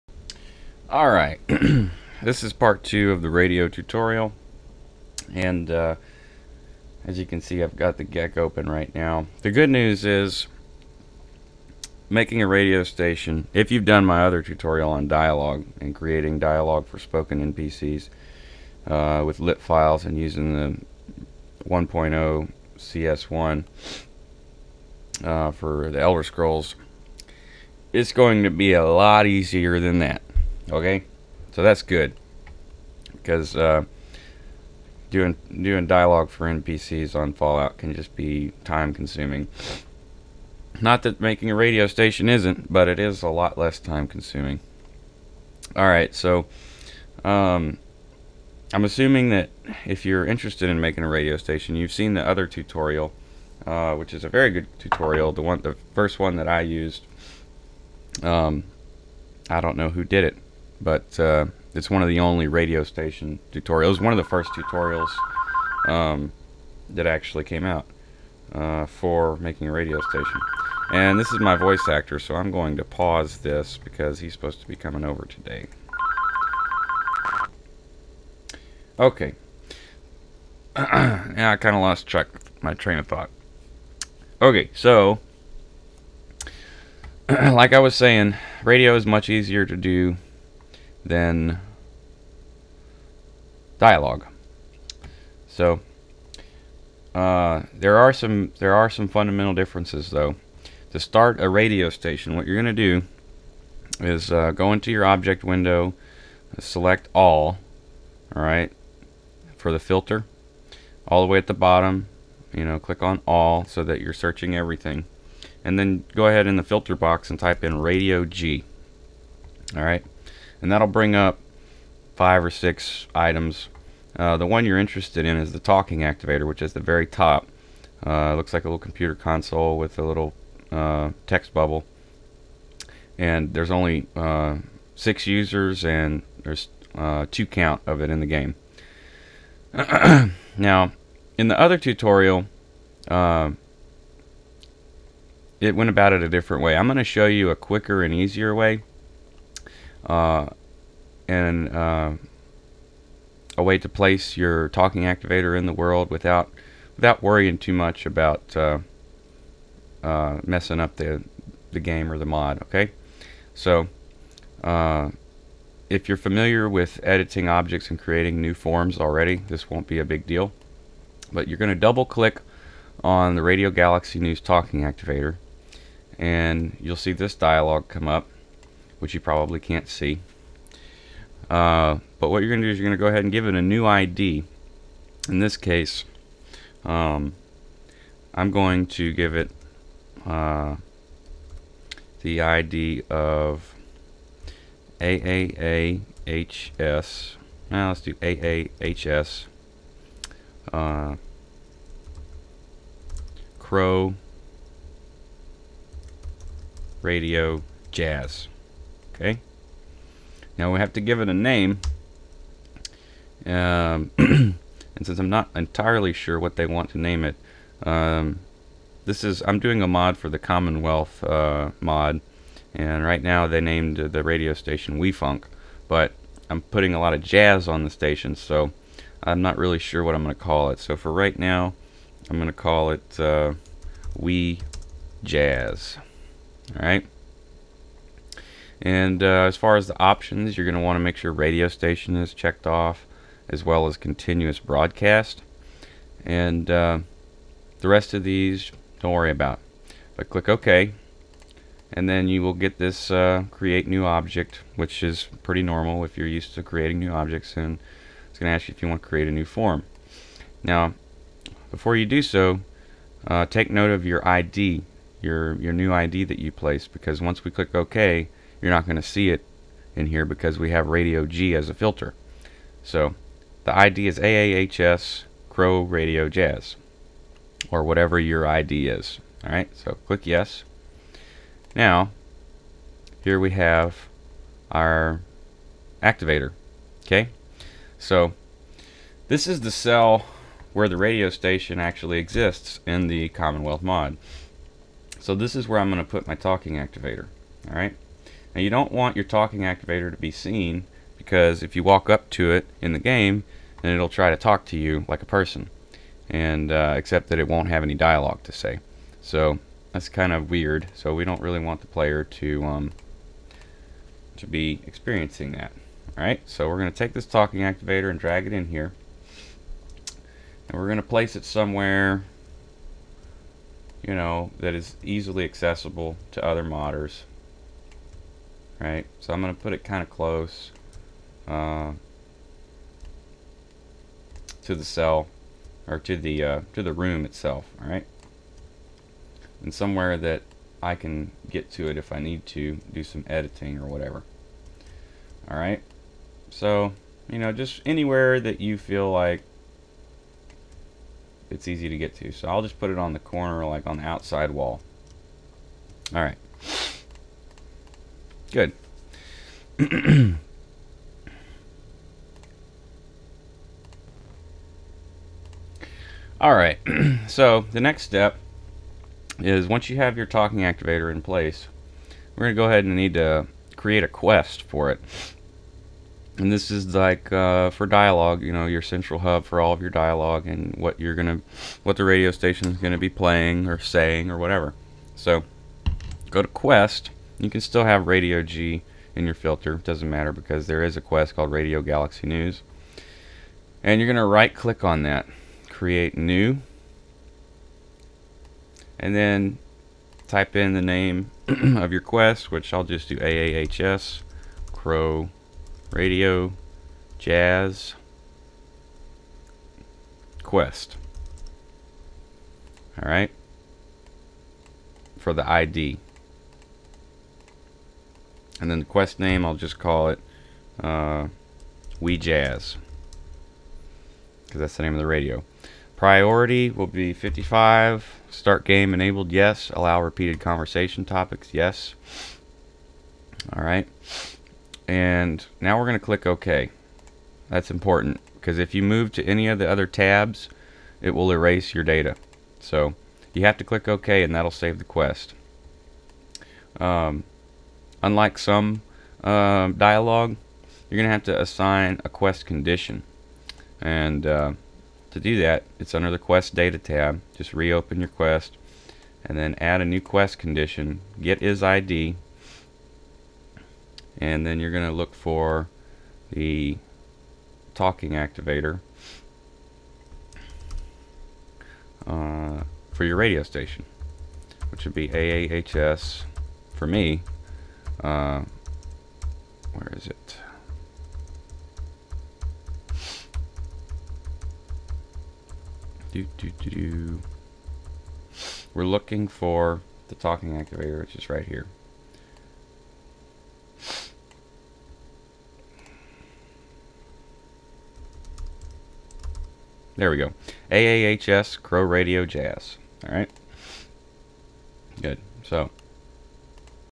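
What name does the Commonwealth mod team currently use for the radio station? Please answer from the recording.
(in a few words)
WeFunk.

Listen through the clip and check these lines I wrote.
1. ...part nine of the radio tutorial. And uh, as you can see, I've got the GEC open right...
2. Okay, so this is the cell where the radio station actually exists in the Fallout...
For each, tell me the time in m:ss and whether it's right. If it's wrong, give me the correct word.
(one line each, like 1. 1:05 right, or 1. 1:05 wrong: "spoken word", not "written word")
1. 0:02 wrong: "two", not "nine"
2. 4:47 wrong: "Commonwealth", not "Fallout".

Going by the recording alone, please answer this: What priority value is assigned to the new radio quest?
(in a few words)
55.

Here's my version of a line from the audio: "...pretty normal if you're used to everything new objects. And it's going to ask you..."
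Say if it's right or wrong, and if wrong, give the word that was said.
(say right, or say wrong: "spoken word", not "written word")
wrong: "creating", not "everything".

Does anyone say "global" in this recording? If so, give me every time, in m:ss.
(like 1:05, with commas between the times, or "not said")
not said.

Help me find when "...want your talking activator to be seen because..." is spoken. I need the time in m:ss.
4:58.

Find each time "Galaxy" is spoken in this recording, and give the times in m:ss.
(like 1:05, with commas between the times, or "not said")
2:53, 6:31.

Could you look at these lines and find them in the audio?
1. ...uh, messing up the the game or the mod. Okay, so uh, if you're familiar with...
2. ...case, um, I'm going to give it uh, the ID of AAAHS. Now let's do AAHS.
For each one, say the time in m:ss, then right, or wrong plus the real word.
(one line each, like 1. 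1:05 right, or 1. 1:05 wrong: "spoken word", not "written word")
1. 2:40 right
2. 3:05 right.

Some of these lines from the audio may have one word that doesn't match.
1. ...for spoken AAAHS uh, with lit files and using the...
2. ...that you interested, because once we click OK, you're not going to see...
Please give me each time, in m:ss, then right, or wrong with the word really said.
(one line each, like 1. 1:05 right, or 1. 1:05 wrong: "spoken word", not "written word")
1. 0:16 wrong: "NPCs", not "AAAHS"
2. 4:26 wrong: "placed", not "interested".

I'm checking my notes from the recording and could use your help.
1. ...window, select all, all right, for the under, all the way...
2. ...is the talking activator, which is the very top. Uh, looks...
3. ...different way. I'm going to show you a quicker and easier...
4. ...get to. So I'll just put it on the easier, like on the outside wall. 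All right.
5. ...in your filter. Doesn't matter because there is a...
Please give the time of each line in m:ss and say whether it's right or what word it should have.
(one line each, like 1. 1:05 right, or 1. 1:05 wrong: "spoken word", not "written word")
1. 1:45 wrong: "filter", not "under"
2. 2:05 right
3. 2:26 right
4. 5:51 wrong: "corner", not "easier"
5. 6:29 right.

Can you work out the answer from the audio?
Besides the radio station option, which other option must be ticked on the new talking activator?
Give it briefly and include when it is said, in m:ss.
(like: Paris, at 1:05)
continuous broadcast, at 4:03.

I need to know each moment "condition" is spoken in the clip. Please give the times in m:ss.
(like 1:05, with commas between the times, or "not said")
7:32, 7:40.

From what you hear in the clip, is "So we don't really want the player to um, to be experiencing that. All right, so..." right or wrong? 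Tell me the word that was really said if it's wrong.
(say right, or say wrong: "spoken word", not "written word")
right.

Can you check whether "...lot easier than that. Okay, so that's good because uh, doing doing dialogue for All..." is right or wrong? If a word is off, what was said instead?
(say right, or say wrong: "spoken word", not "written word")
wrong: "NPCs", not "All".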